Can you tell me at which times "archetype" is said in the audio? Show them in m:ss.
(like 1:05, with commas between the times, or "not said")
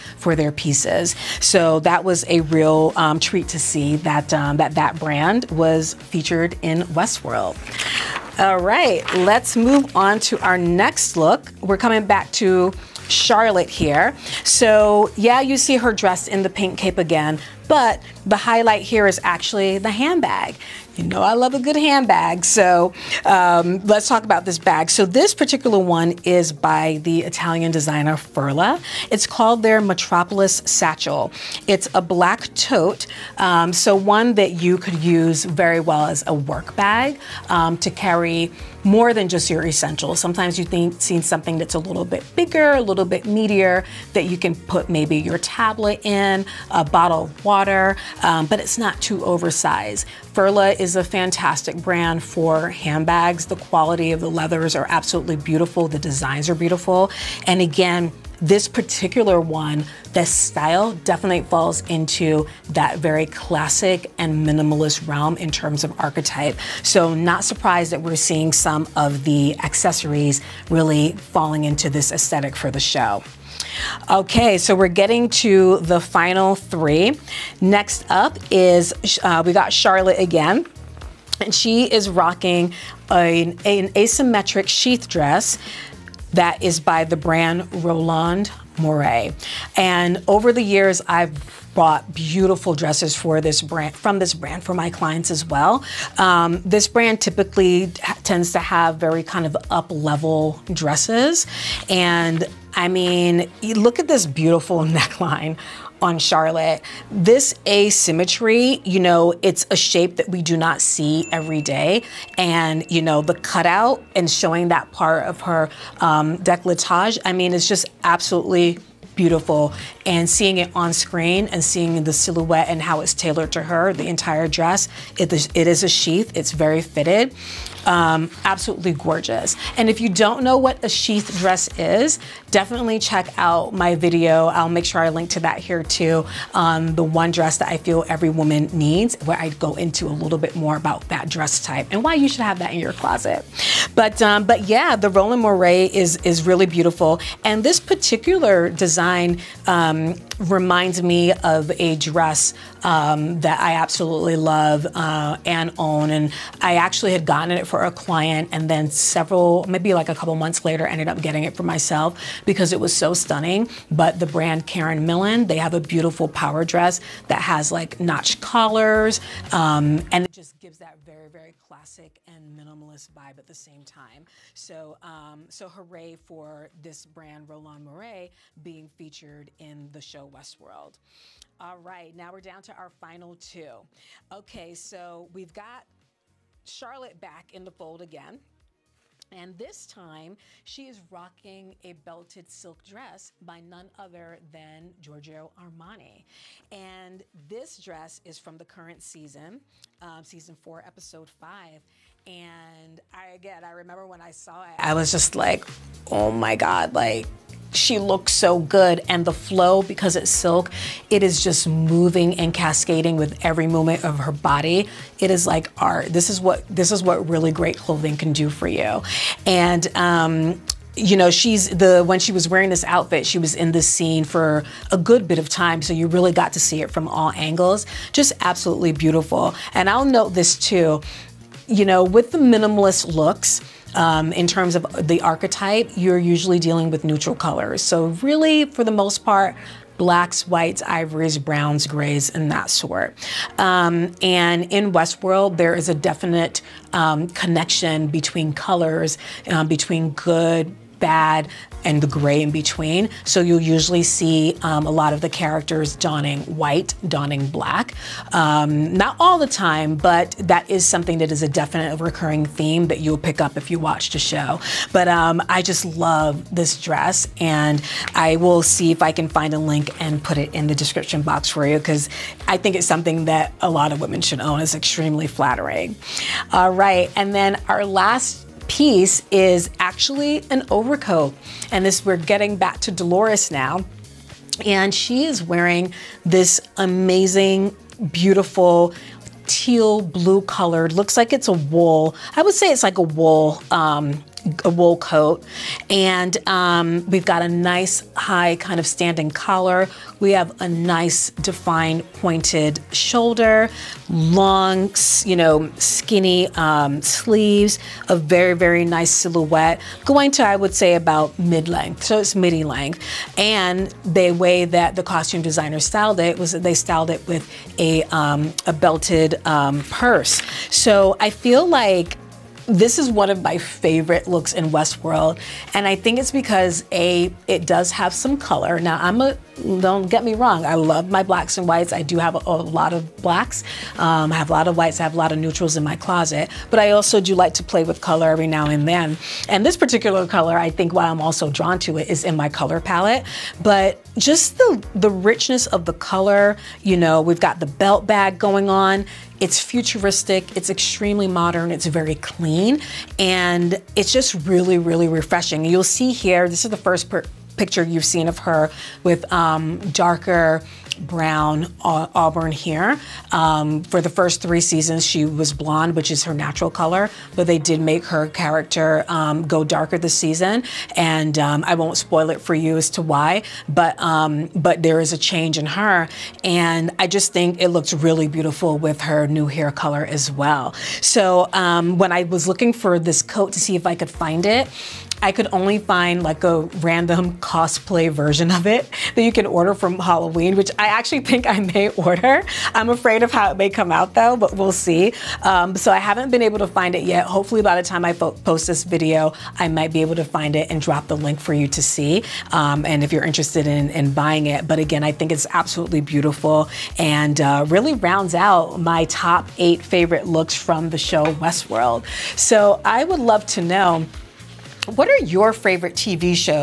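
1:05, 3:55.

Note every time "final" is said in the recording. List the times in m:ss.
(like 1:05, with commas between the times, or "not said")
1:15, 3:02.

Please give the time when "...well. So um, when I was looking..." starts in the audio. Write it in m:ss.
6:20.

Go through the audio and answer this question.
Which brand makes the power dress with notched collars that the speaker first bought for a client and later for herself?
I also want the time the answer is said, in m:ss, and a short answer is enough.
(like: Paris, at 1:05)
Karen Millen, at 2:44.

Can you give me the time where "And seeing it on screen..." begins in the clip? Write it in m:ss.
2:00.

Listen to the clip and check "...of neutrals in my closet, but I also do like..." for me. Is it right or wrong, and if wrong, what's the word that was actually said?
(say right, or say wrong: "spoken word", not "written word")
right.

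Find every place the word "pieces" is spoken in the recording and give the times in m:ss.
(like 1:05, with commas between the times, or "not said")
0:00, 4:38.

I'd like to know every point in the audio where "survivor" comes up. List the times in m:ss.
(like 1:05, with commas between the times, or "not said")
not said.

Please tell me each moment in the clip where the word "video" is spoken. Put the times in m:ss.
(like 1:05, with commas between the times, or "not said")
2:13, 6:38.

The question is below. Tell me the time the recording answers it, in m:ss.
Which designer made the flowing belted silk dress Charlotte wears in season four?
3:15.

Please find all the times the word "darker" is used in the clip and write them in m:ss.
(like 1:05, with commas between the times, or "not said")
5:59, 6:09.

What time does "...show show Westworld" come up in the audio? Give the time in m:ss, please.
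3:00.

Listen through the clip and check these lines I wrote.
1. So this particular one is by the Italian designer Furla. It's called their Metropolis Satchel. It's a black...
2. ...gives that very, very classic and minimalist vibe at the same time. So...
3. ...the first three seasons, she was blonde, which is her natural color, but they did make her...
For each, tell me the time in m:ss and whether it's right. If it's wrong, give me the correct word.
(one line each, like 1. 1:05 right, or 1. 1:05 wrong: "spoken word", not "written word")
1. 0:24 right
2. 2:50 right
3. 6:03 right.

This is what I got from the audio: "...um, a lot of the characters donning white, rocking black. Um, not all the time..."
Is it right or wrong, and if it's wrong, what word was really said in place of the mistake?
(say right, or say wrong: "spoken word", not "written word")
wrong: "donning", not "rocking".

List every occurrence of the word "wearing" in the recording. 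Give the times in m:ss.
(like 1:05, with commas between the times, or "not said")
3:42, 4:45.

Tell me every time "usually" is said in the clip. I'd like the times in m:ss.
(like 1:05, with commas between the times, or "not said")
3:56, 4:13.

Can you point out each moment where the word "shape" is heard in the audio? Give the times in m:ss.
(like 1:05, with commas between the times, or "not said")
1:49.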